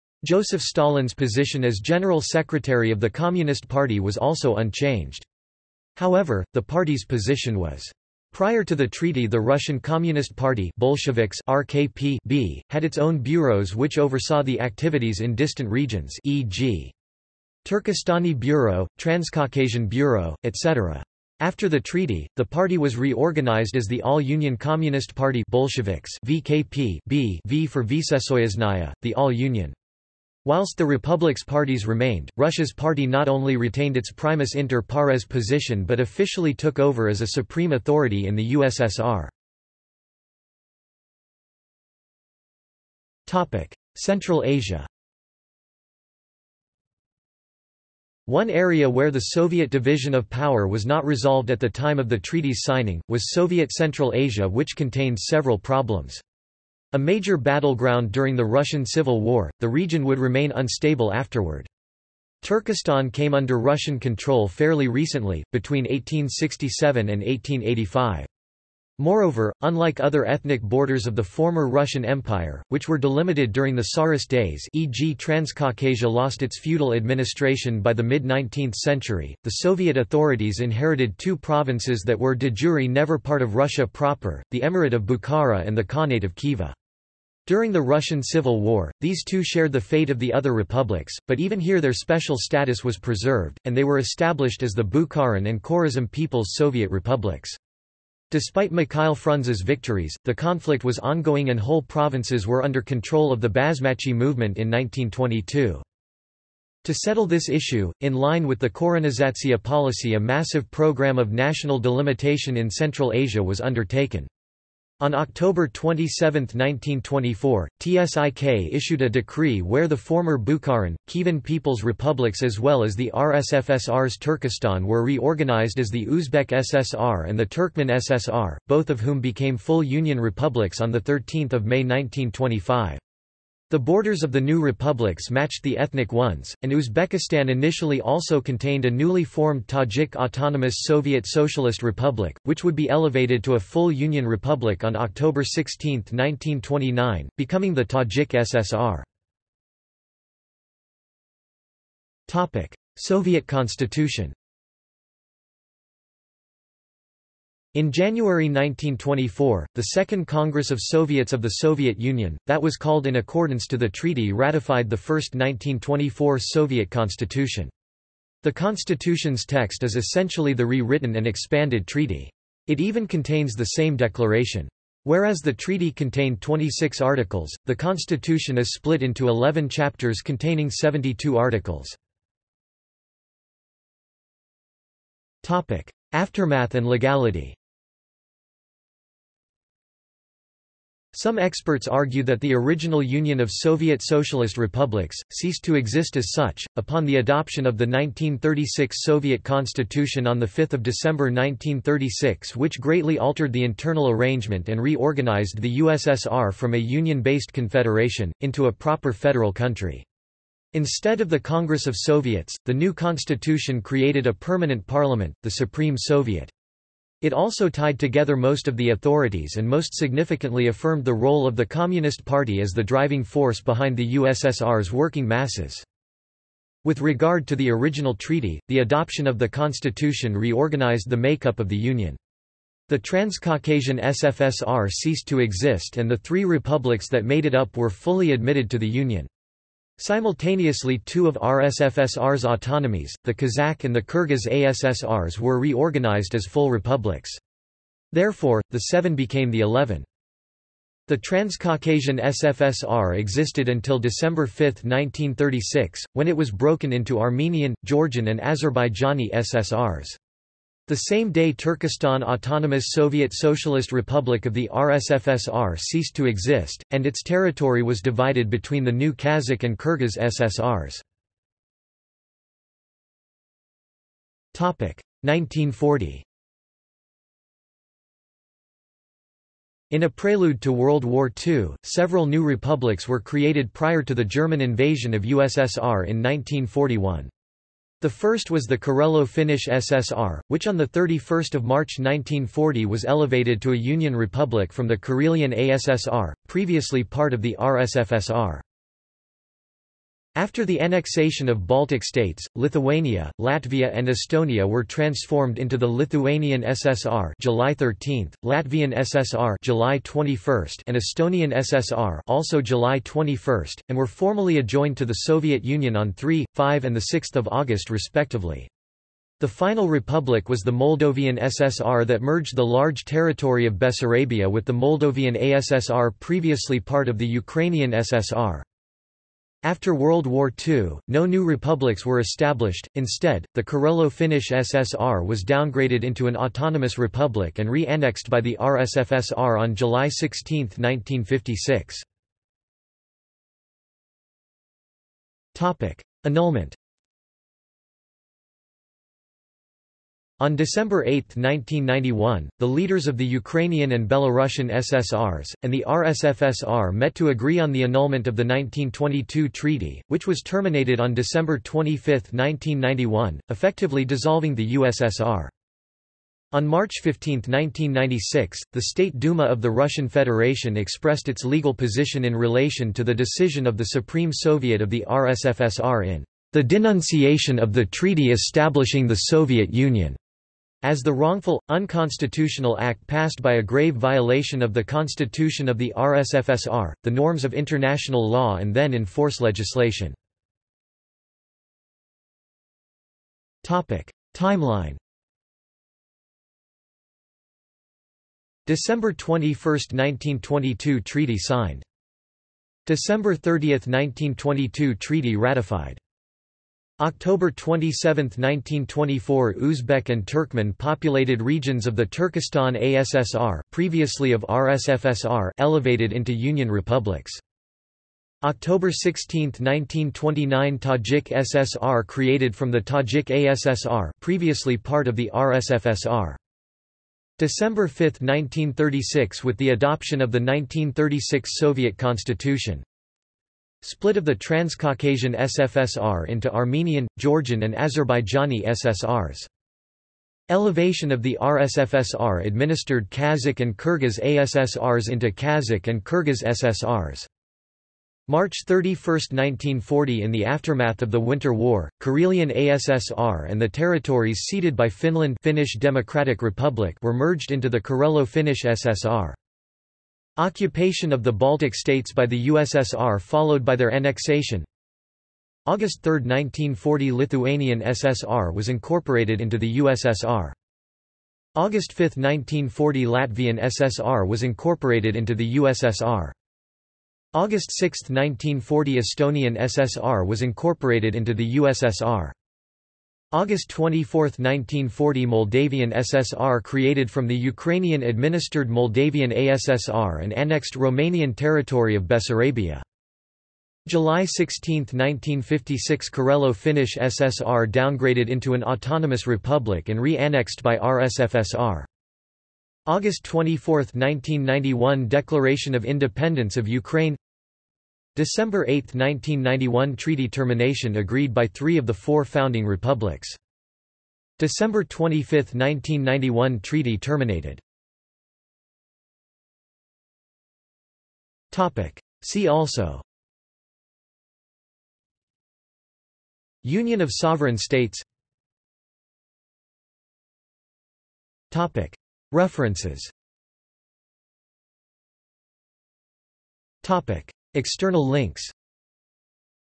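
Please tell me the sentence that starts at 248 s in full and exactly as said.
Therefore, the seven became the eleven.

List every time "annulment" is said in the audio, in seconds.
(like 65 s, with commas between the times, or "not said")
346 s, 357 s.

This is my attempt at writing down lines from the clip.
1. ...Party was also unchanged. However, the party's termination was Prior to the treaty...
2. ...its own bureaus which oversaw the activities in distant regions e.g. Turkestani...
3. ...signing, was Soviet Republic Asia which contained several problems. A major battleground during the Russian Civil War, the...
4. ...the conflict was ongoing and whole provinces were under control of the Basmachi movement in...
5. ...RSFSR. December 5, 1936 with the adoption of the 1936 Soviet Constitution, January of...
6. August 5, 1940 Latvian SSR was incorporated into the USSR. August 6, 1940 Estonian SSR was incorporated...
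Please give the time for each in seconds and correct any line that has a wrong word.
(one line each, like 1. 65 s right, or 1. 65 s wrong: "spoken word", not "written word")
1. 3 s wrong: "position", not "termination"
2. 12 s right
3. 52 s wrong: "Central", not "Republic"
4. 100 s right
5. 425 s wrong: "Split", not "January"
6. 471 s right.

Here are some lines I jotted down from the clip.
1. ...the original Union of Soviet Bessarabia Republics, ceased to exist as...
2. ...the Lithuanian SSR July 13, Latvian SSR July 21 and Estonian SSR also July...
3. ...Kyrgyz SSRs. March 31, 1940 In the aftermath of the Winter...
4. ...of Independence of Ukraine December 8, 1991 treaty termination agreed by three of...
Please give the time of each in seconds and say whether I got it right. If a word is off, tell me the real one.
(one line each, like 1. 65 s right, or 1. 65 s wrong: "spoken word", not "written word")
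1. 192 s wrong: "Socialist", not "Bessarabia"
2. 305 s right
3. 446 s right
4. 505 s right.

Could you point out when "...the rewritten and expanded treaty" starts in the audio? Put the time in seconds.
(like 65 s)
170 s.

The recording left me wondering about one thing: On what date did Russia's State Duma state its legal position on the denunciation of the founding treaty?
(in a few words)
March 15, 1996.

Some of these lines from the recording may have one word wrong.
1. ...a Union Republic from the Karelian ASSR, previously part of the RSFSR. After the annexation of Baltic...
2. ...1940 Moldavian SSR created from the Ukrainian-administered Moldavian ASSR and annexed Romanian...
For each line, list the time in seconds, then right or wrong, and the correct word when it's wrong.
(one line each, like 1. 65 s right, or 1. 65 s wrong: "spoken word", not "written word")
1. 293 s right
2. 484 s right.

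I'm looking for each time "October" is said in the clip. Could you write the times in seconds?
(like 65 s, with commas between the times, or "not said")
115 s, 144 s, 407 s, 418 s.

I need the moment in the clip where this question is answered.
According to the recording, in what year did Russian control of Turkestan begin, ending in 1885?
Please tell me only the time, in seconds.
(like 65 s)
65 s.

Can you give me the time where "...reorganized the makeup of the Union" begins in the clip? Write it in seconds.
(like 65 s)
230 s.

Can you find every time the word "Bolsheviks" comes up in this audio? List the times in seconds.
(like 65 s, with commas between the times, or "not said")
10 s, 25 s.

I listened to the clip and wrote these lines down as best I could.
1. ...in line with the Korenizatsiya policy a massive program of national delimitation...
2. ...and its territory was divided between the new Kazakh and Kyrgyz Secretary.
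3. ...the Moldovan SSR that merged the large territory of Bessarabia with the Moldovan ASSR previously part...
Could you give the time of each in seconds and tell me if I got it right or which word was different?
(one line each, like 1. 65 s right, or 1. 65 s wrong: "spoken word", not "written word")
1. 108 s right
2. 266 s wrong: "SSRs", not "Secretary"
3. 320 s right.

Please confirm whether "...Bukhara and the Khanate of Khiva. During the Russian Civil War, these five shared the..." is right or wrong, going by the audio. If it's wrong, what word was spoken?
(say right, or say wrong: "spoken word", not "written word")
wrong: "two", not "five".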